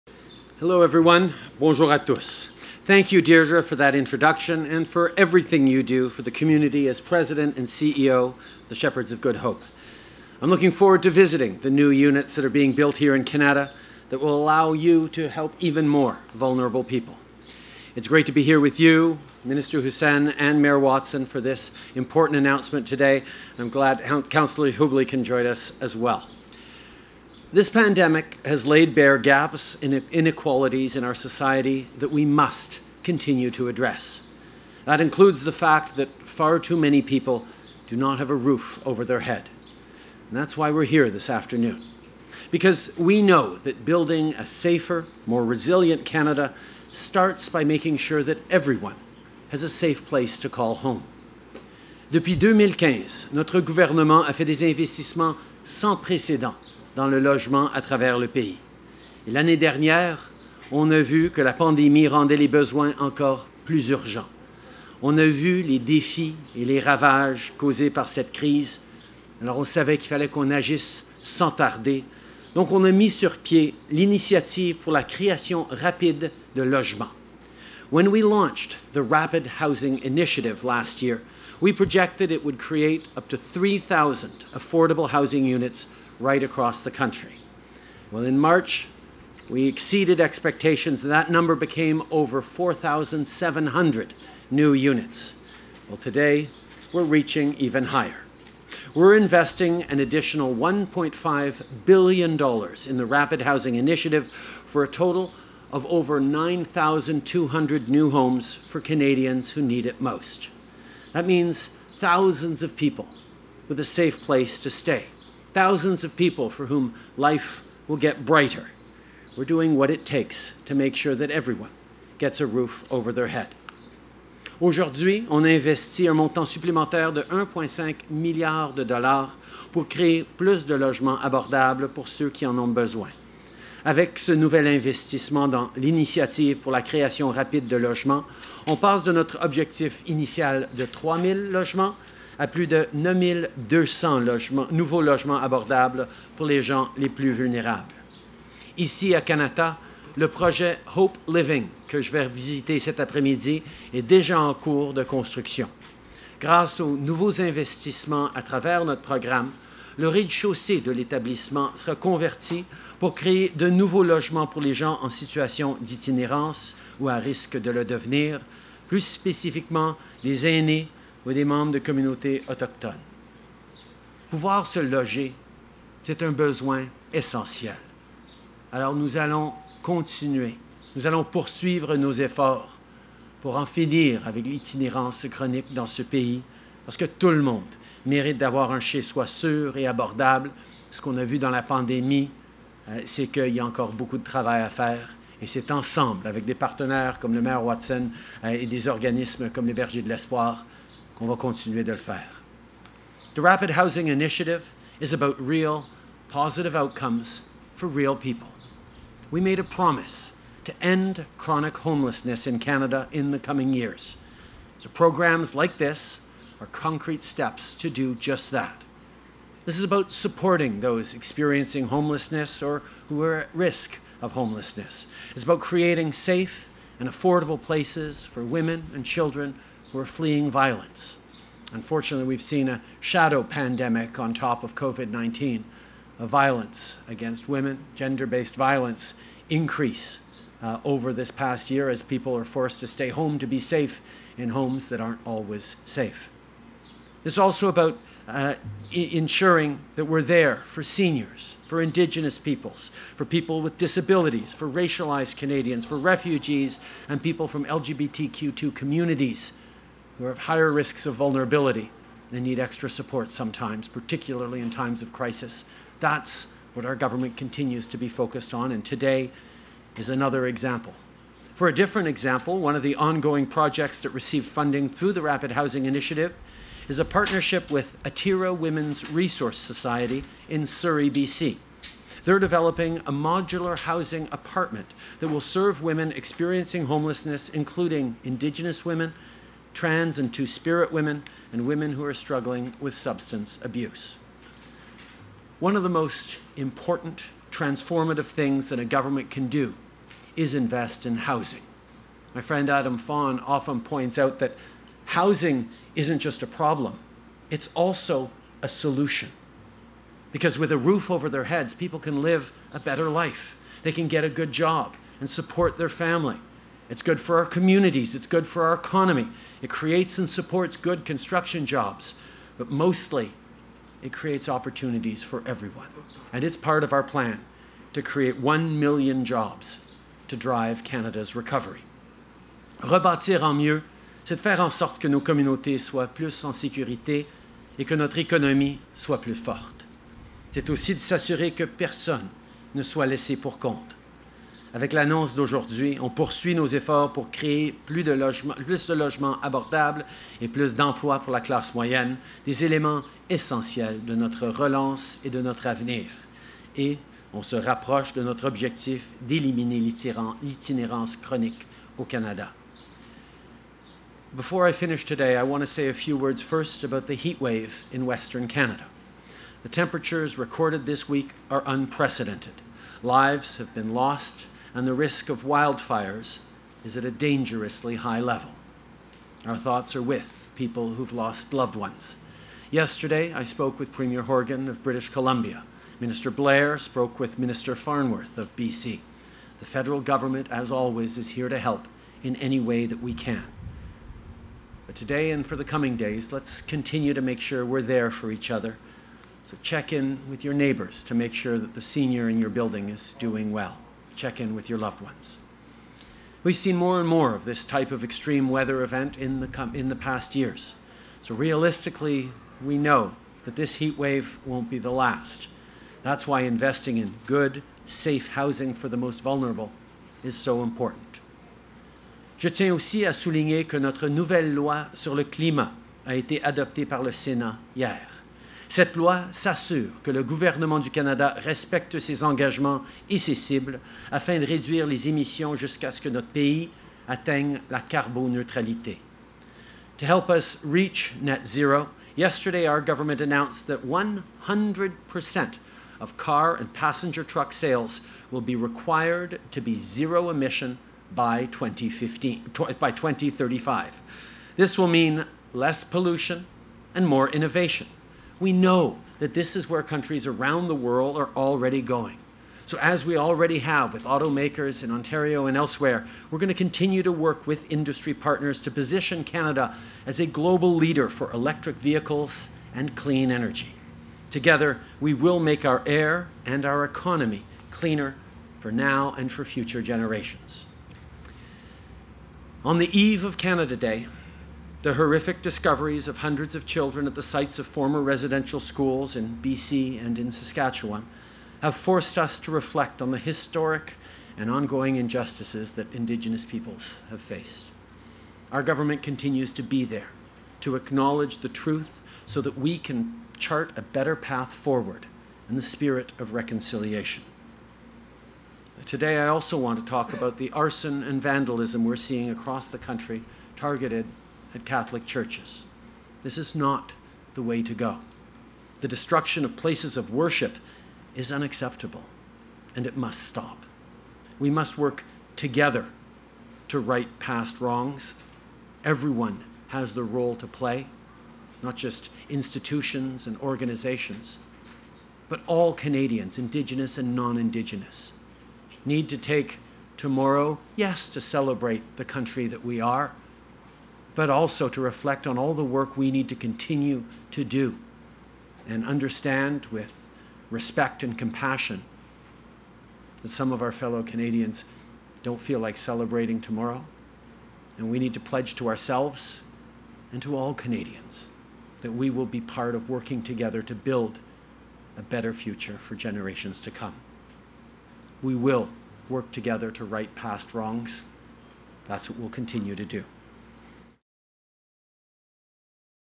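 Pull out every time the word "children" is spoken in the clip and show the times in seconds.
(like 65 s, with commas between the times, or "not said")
229 s, 486 s.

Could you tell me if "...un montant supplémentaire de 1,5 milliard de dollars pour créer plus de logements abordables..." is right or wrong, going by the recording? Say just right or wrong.
right.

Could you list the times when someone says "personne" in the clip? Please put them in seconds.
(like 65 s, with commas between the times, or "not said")
341 s.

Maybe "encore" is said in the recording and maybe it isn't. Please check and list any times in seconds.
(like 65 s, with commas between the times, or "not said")
62 s, 193 s.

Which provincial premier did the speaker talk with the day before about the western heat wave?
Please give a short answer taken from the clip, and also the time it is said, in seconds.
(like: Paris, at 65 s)
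Premier Horgan, at 383 s.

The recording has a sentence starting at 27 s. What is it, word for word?
This pandemic has laid bare gaps and inequalities in our society that we must continue to address.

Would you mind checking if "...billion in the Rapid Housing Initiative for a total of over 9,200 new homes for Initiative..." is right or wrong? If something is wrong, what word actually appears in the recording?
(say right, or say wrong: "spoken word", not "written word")
wrong: "Canadians", not "Initiative".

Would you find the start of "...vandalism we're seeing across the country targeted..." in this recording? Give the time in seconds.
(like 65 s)
511 s.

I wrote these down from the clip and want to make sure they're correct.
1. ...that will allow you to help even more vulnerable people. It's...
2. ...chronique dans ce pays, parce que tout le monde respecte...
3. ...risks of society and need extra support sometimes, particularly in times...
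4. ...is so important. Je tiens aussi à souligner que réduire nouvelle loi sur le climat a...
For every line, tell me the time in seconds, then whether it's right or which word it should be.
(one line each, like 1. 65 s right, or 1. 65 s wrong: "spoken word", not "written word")
1. 14 s right
2. 185 s wrong: "mérite", not "respecte"
3. 260 s wrong: "vulnerability", not "society"
4. 420 s wrong: "notre", not "réduire".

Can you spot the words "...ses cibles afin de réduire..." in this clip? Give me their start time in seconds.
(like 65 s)
433 s.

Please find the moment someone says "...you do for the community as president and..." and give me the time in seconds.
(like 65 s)
5 s.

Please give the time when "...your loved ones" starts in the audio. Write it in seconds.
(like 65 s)
404 s.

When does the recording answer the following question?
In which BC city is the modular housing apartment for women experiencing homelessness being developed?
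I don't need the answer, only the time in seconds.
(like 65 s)
280 s.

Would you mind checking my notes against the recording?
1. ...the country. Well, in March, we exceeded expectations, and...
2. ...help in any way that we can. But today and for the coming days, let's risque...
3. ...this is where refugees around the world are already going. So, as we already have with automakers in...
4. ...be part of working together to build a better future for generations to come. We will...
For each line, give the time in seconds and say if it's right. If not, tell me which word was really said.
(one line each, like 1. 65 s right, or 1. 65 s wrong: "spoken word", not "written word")
1. 86 s right
2. 391 s wrong: "continue", not "risque"
3. 459 s wrong: "countries", not "refugees"
4. 562 s right.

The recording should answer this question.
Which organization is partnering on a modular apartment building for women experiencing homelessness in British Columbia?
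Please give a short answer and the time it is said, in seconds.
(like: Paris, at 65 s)
Atira Women's Resource Society, at 278 s.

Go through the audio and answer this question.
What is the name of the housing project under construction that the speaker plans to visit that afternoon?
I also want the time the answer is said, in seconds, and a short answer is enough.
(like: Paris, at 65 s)
Hope Living, at 150 s.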